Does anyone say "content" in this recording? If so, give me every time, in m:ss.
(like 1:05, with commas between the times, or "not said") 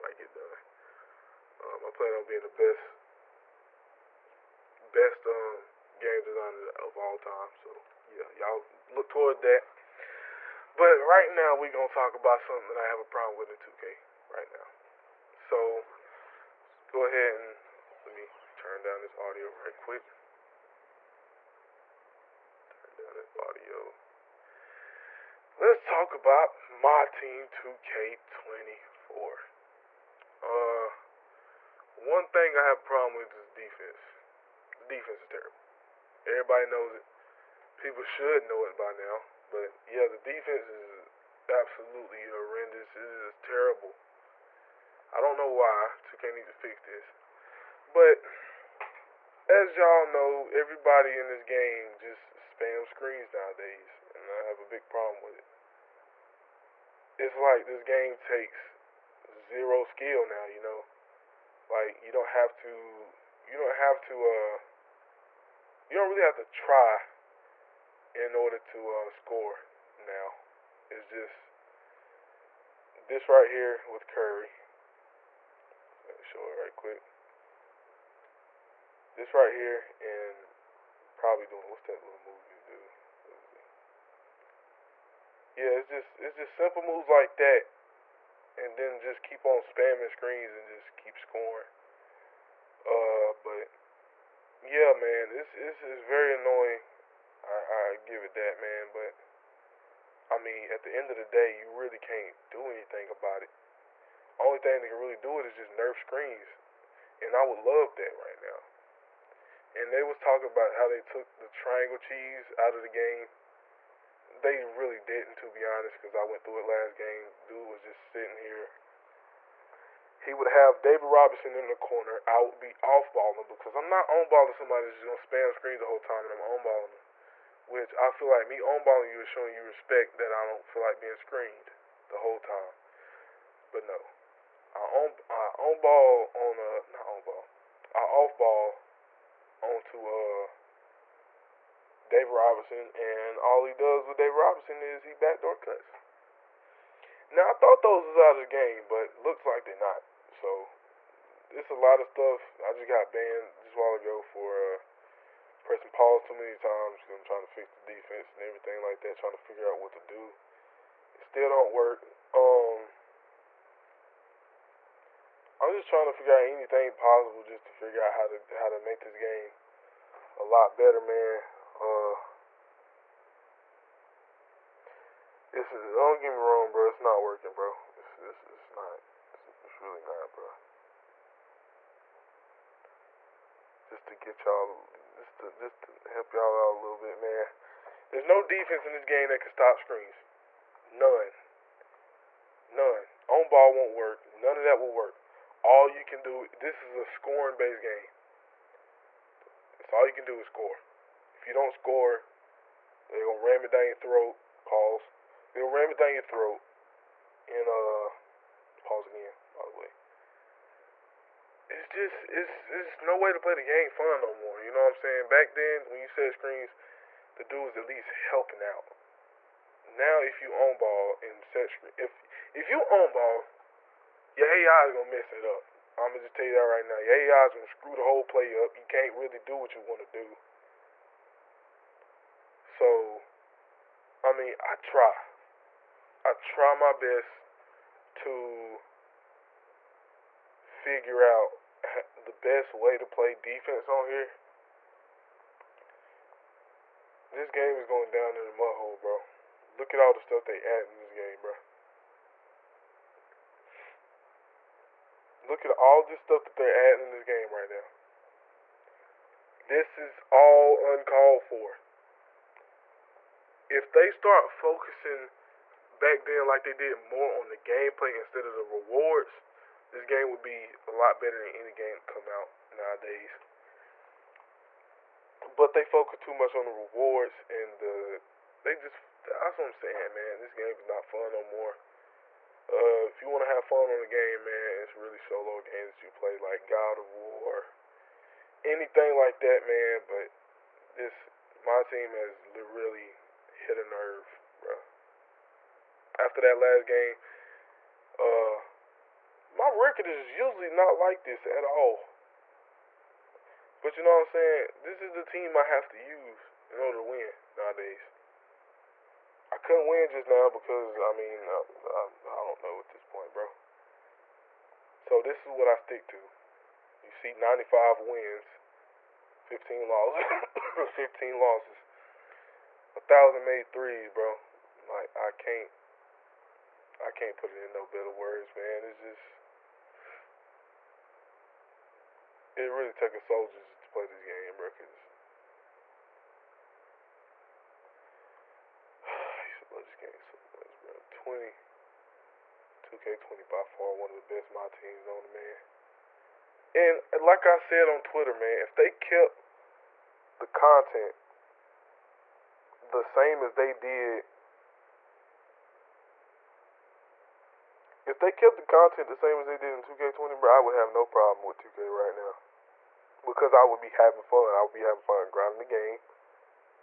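5:50, 5:58.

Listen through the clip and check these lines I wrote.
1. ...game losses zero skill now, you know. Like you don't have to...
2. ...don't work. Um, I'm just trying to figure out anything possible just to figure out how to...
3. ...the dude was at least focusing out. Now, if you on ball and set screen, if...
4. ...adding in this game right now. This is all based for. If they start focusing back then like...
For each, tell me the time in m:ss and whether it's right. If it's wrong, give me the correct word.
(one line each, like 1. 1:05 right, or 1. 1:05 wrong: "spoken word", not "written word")
1. 0:57 wrong: "takes", not "losses"
2. 2:41 right
3. 3:37 wrong: "helping", not "focusing"
4. 4:16 wrong: "uncalled", not "based".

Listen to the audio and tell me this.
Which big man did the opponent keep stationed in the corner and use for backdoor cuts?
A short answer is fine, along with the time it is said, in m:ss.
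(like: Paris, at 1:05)
David Robinson, at 2:00.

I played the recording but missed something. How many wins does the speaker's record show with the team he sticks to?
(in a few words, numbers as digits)
95.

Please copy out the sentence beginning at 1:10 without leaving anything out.
It's just this right here with Curry.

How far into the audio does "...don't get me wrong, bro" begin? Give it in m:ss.
2:55.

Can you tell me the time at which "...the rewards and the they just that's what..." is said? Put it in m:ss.
4:36.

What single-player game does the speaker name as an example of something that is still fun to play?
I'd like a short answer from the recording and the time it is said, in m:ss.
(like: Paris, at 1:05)
God of War, at 4:46.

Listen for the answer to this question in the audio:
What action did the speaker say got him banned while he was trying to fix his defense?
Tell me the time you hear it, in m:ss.
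2:35.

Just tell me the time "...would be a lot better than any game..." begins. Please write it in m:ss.
4:30.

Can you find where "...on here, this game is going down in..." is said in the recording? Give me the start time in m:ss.
4:03.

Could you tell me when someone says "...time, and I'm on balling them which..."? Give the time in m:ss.
2:05.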